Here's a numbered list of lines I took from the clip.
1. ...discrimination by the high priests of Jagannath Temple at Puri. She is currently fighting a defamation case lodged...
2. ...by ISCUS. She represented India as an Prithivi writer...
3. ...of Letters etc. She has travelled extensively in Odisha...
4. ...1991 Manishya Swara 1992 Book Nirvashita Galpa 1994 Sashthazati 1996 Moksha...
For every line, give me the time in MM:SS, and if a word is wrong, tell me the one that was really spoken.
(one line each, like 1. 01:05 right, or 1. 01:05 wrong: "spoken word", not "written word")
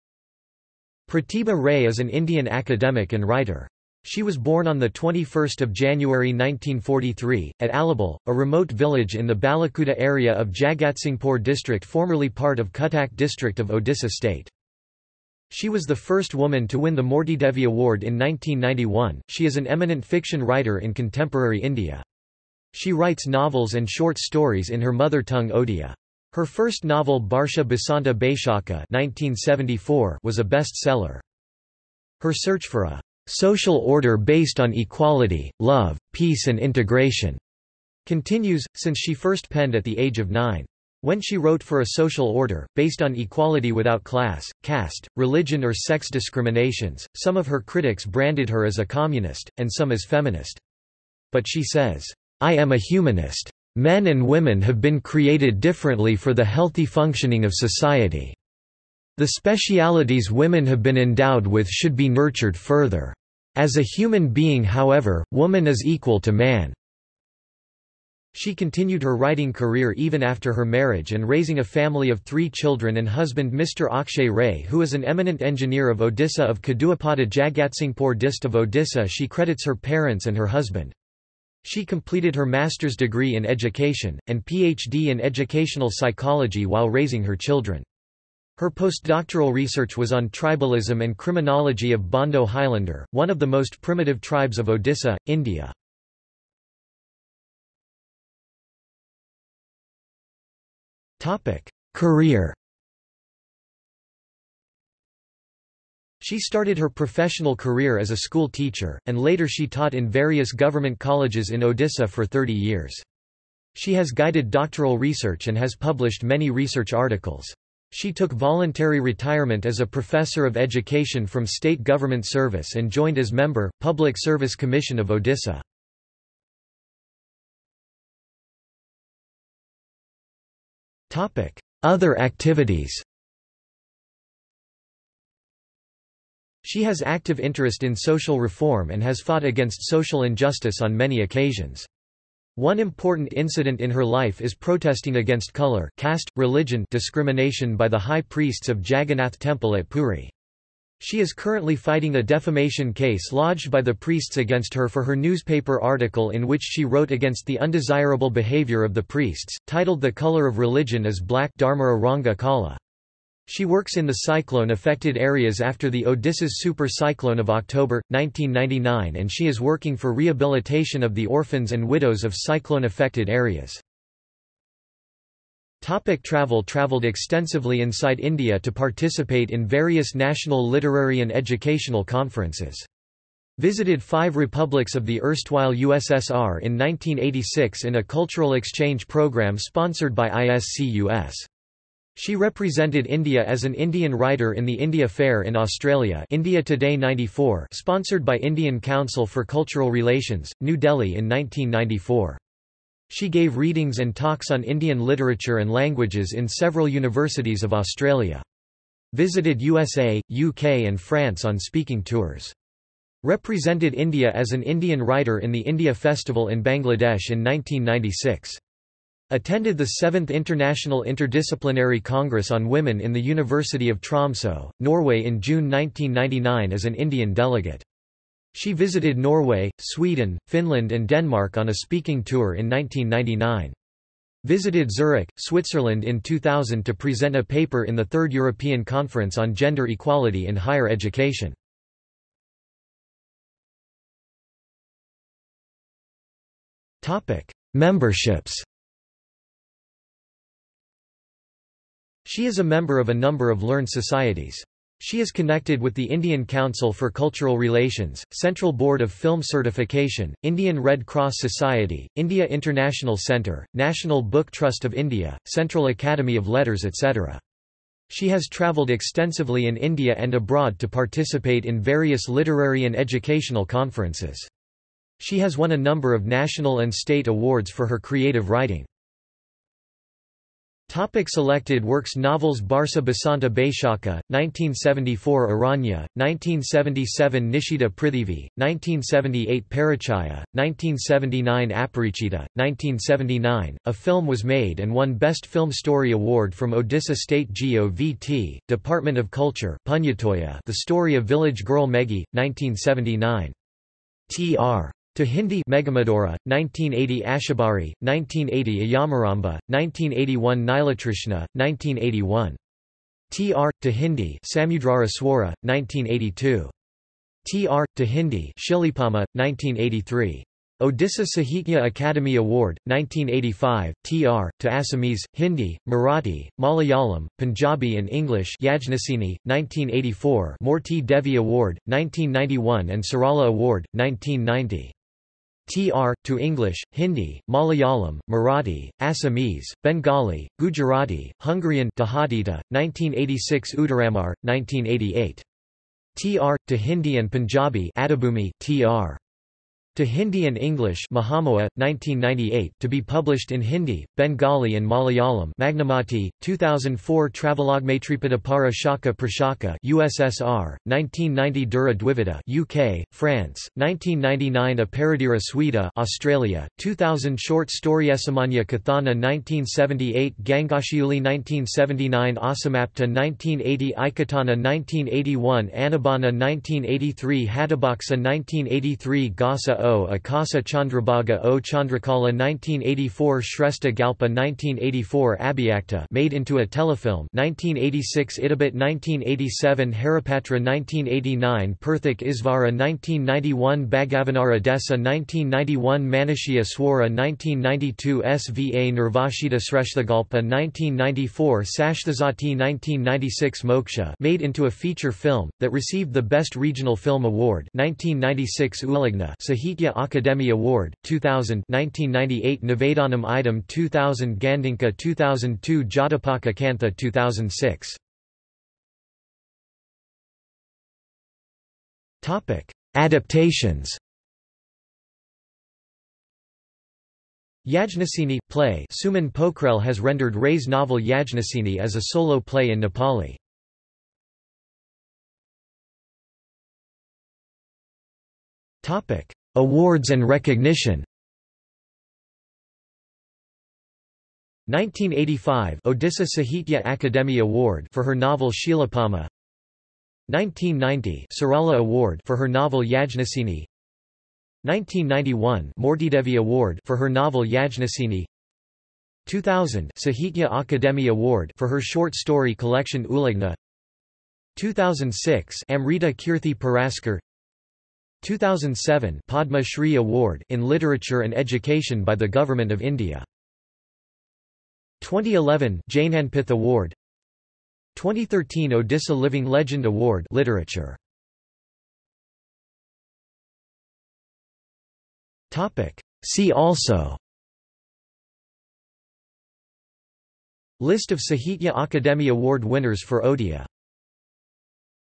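1. 02:26 right
2. 03:10 wrong: "Indian", not "Prithivi"
3. 04:26 wrong: "India", not "Odisha"
4. 06:35 wrong: "Sva", not "Book".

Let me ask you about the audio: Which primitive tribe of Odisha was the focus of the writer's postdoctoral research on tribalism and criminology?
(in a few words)
Bondo Highlander.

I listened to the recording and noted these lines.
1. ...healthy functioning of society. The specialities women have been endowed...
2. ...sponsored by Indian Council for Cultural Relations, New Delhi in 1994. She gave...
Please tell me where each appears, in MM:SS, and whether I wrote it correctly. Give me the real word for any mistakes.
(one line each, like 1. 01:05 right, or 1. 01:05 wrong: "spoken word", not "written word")
1. 00:56 right
2. 03:17 right.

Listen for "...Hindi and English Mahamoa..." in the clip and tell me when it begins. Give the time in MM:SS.
05:50.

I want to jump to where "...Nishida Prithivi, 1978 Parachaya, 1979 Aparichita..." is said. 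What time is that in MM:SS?
04:47.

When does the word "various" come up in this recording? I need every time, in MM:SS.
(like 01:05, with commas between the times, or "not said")
01:50, 02:59, 04:31.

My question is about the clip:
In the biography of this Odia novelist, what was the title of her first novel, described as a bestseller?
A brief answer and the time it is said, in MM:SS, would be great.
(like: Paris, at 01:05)
Barsha Basanta Baishaka, at 00:27.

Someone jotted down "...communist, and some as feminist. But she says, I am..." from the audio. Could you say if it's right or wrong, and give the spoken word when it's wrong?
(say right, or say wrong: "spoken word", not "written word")
right.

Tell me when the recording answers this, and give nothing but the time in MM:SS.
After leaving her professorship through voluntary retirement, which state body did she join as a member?
02:03.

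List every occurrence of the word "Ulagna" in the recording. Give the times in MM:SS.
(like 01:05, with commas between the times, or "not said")
06:48, 07:43.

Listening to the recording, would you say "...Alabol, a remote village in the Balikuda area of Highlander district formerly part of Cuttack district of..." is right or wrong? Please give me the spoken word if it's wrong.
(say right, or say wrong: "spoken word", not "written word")
wrong: "Jagatsinghpur", not "Highlander".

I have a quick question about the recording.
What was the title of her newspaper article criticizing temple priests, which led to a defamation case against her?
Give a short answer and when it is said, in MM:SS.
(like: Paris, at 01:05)
The Color of Religion is Black, at 02:39.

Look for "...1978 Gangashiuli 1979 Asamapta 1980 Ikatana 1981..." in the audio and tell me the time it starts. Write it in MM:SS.
06:09.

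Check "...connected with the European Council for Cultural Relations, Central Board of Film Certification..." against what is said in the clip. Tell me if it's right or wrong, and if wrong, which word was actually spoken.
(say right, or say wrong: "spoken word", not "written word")
wrong: "Indian", not "European".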